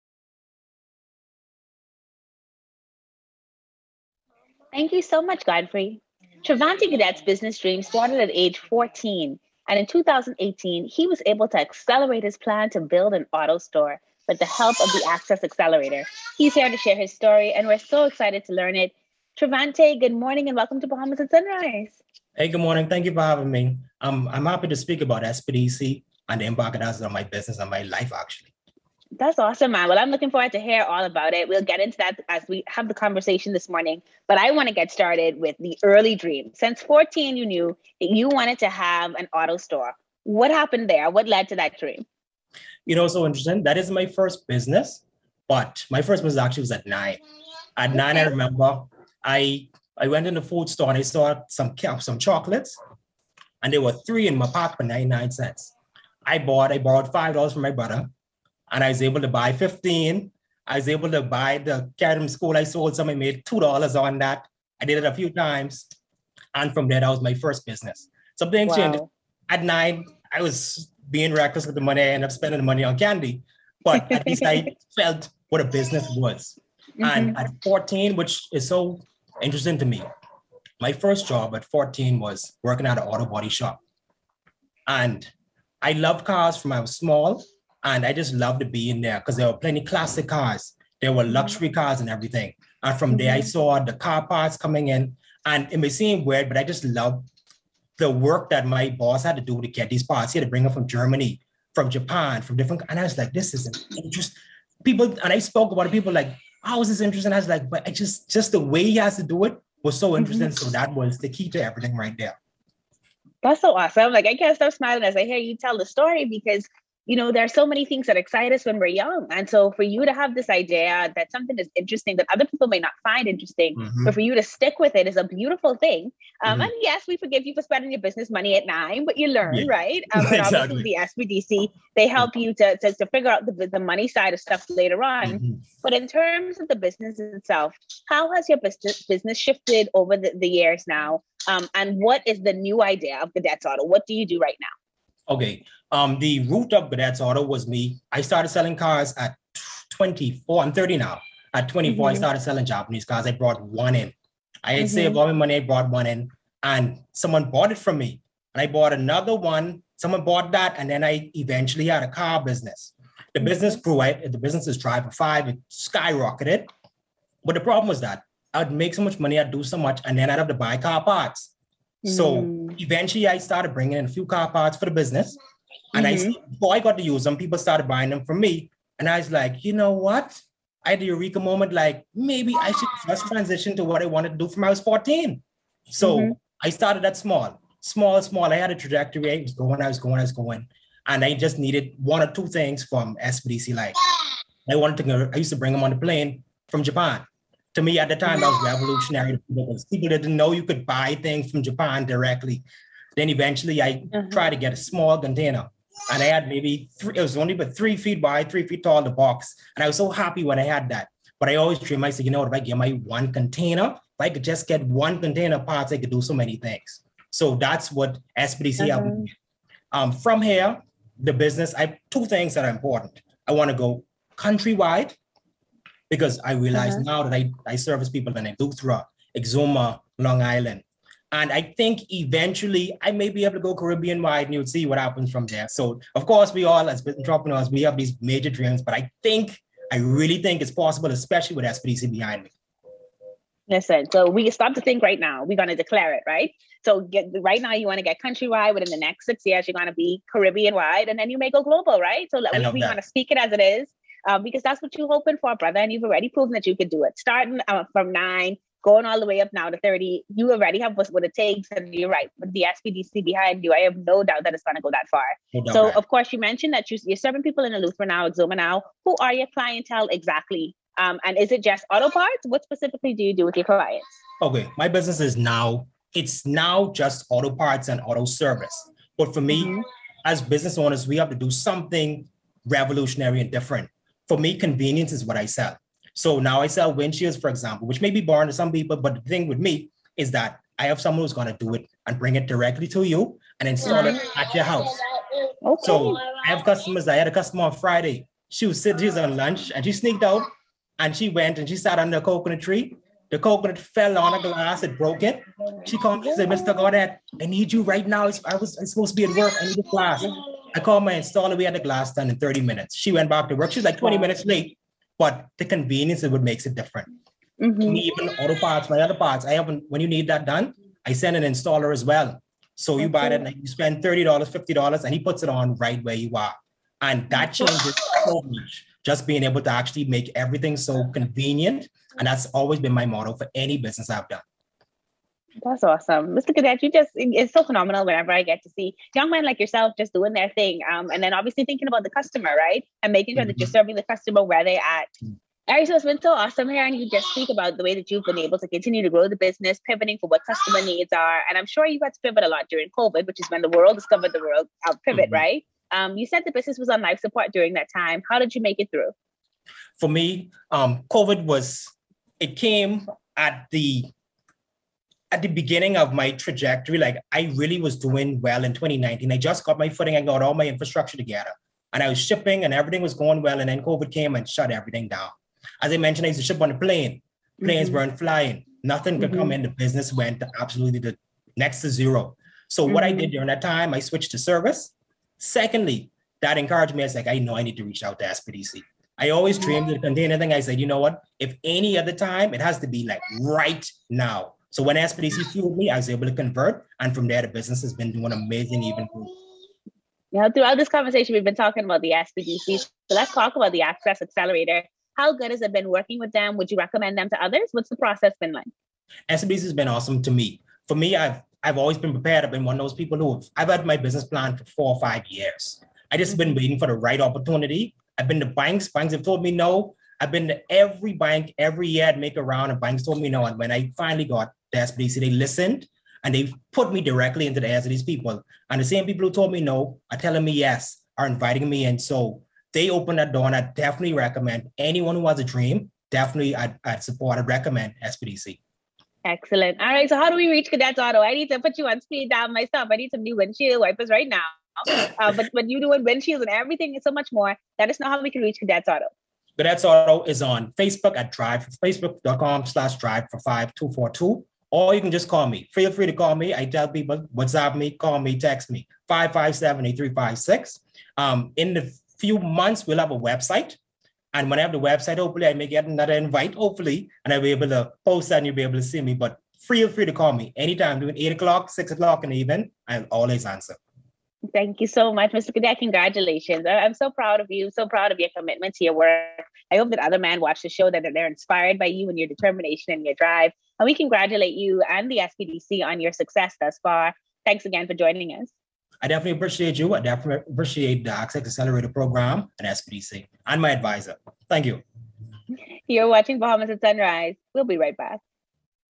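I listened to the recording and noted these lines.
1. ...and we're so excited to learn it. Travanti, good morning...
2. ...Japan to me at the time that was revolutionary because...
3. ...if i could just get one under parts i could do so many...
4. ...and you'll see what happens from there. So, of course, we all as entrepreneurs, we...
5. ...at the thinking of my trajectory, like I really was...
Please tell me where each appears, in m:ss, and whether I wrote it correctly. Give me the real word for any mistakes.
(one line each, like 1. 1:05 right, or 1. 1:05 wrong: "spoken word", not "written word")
1. 0:17 right
2. 3:16 right
3. 3:33 wrong: "container", not "under"
4. 3:54 right
5. 6:05 wrong: "beginning", not "thinking".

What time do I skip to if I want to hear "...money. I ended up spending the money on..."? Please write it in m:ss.
1:11.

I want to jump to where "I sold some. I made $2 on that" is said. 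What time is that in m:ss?
1:02.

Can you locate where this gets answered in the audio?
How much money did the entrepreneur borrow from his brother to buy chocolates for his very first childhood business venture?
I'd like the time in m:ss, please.
0:57.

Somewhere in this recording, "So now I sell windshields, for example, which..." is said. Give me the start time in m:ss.
4:46.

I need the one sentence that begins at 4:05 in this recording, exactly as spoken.
We're going to declare it, right?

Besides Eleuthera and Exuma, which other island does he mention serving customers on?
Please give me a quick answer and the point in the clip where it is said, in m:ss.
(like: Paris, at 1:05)
Long Island, at 3:50.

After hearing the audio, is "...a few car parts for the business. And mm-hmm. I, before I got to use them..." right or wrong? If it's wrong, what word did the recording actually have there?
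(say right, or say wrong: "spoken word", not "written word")
right.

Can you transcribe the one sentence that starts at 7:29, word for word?
Godet's Auto is on Facebook at Drive, facebook.com slash Drive for 5242 or you can just call me.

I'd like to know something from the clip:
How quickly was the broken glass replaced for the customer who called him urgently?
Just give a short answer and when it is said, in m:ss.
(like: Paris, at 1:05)
30 minutes, at 5:12.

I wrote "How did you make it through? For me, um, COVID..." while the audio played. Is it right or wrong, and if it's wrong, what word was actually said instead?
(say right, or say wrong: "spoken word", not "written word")
right.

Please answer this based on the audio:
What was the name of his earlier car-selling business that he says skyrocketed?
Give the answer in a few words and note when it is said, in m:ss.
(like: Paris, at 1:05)
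Drive for Five, at 2:44.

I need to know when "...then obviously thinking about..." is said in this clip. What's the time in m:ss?
5:41.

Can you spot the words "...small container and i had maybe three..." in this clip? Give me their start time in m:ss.
3:24.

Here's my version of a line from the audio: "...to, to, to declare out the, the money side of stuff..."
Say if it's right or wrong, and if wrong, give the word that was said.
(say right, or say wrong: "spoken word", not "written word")
wrong: "figure", not "declare".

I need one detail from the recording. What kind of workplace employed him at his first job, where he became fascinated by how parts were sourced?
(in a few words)
Auto body shop.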